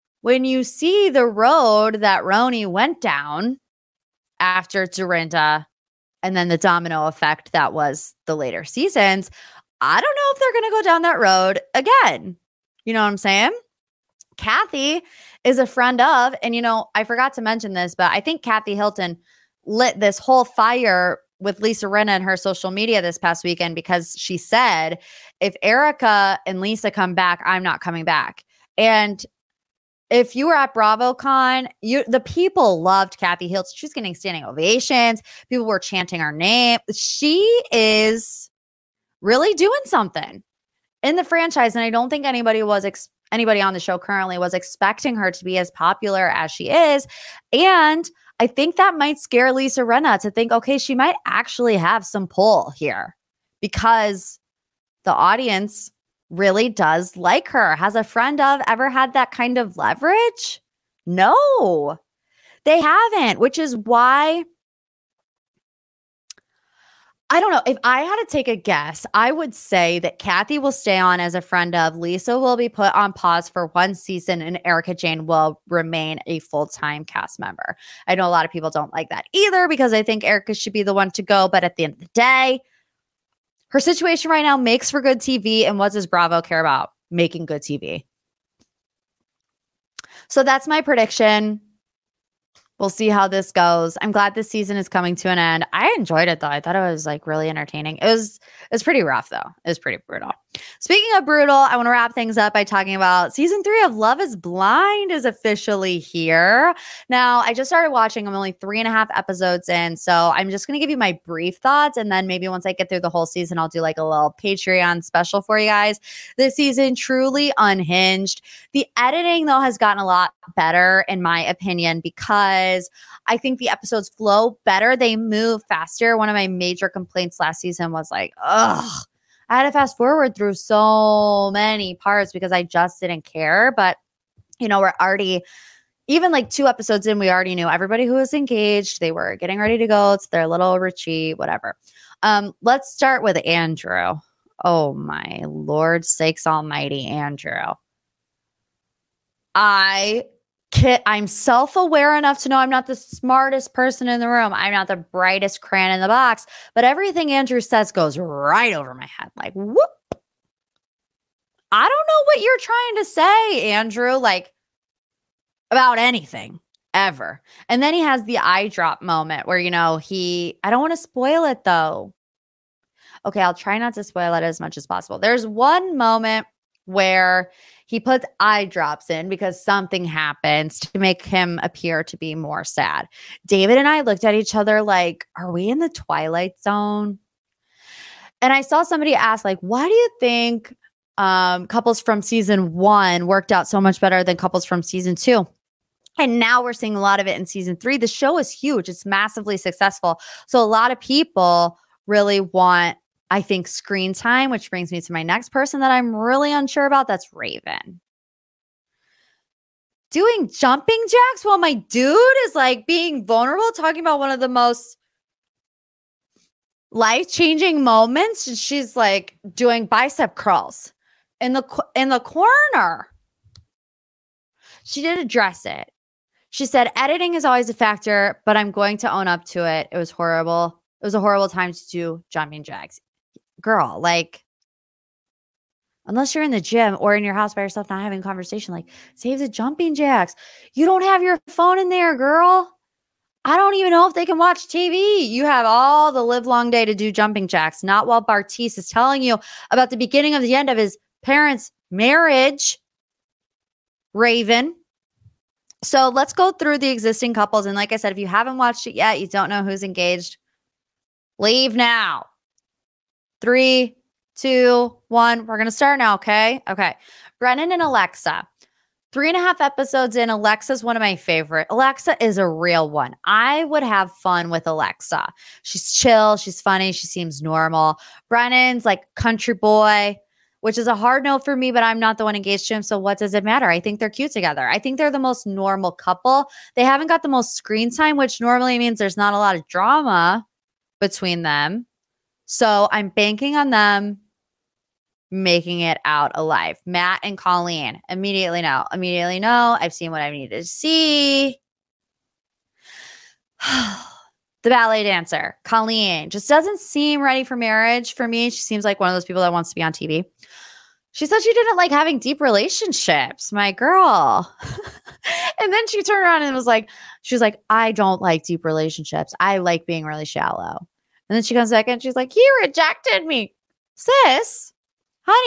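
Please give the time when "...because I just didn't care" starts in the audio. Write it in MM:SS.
02:12.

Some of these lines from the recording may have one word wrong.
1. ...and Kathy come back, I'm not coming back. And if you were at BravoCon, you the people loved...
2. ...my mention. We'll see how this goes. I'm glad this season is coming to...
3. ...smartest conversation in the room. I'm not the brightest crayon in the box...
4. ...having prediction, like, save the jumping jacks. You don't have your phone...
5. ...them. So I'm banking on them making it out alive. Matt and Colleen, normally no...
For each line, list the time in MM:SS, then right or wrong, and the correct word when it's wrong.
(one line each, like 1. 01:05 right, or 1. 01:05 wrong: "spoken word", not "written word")
1. 00:26 wrong: "Lisa", not "Kathy"
2. 01:30 wrong: "prediction", not "mention"
3. 02:32 wrong: "person", not "conversation"
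4. 03:58 wrong: "conversation", not "prediction"
5. 04:51 wrong: "immediately", not "normally".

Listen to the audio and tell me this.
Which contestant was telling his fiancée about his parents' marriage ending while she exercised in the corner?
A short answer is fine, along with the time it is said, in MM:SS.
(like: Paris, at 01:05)
Bartise, at 04:08.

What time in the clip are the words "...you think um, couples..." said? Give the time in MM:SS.
03:09.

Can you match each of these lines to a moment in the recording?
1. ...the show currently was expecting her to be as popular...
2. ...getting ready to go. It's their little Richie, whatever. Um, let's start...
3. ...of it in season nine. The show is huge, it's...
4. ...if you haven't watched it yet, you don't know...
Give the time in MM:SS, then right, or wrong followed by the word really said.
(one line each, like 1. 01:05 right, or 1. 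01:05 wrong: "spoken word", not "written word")
1. 00:43 right
2. 02:19 right
3. 03:17 wrong: "three", not "nine"
4. 04:18 right.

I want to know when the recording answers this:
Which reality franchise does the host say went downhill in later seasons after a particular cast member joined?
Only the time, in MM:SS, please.
00:02.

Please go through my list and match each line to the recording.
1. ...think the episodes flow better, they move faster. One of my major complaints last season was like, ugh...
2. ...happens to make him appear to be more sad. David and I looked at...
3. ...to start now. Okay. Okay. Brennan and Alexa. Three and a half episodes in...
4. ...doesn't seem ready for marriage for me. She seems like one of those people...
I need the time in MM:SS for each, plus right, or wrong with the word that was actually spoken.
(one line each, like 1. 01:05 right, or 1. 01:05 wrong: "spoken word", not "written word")
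1. 02:03 right
2. 03:00 right
3. 04:25 right
4. 05:06 right.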